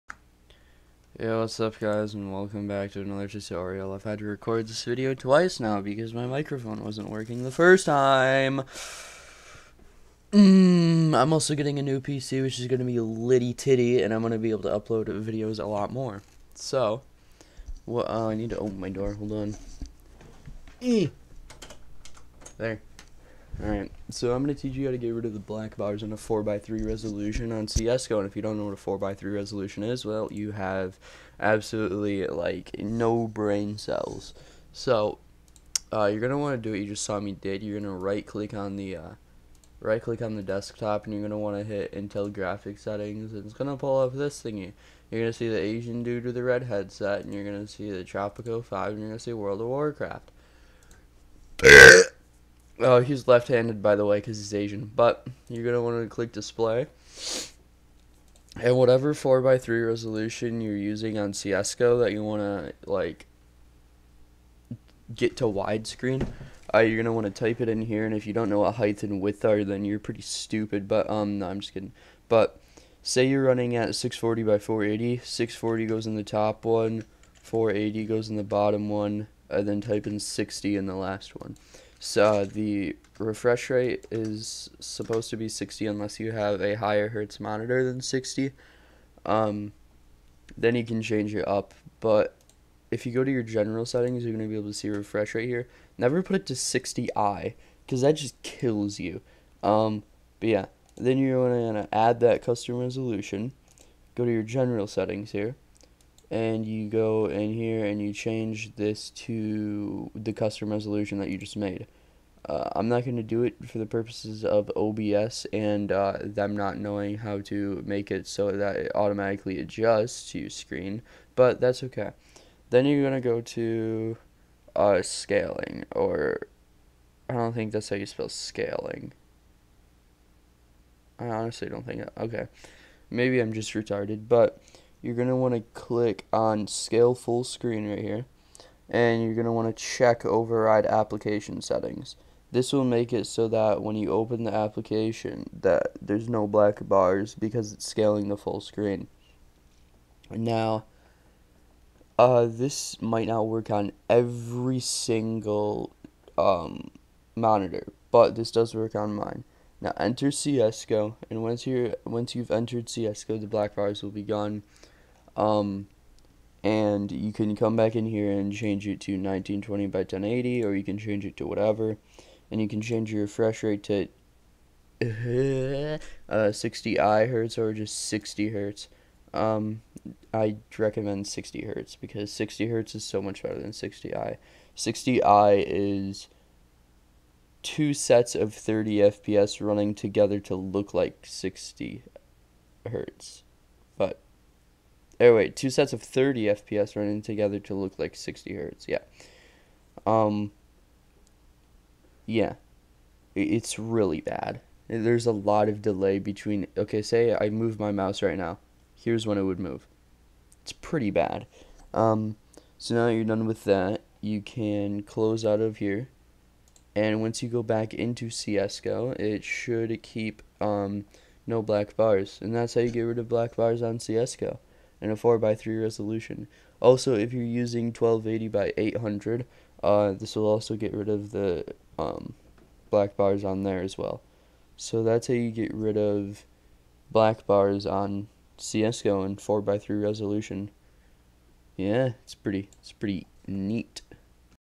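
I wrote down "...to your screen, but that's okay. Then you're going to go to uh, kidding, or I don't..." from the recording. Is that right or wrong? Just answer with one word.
wrong.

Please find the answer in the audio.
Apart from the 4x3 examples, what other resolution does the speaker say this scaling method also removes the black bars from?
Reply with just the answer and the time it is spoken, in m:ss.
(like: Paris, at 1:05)
1280 by 800, at 3:47.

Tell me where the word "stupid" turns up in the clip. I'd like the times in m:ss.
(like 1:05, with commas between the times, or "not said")
1:10.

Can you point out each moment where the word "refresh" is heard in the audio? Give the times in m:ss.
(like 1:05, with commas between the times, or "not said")
1:23, 1:34, 2:53.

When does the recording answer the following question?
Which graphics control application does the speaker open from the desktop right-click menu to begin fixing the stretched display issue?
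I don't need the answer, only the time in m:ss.
0:41.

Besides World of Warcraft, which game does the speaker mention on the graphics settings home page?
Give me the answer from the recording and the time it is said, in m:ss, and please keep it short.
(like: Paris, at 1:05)
Tropico 5, at 0:48.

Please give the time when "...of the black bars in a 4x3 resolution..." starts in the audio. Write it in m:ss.
0:25.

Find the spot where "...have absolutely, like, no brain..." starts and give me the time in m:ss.
0:30.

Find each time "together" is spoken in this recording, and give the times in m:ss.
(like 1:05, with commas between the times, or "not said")
3:09, 3:17.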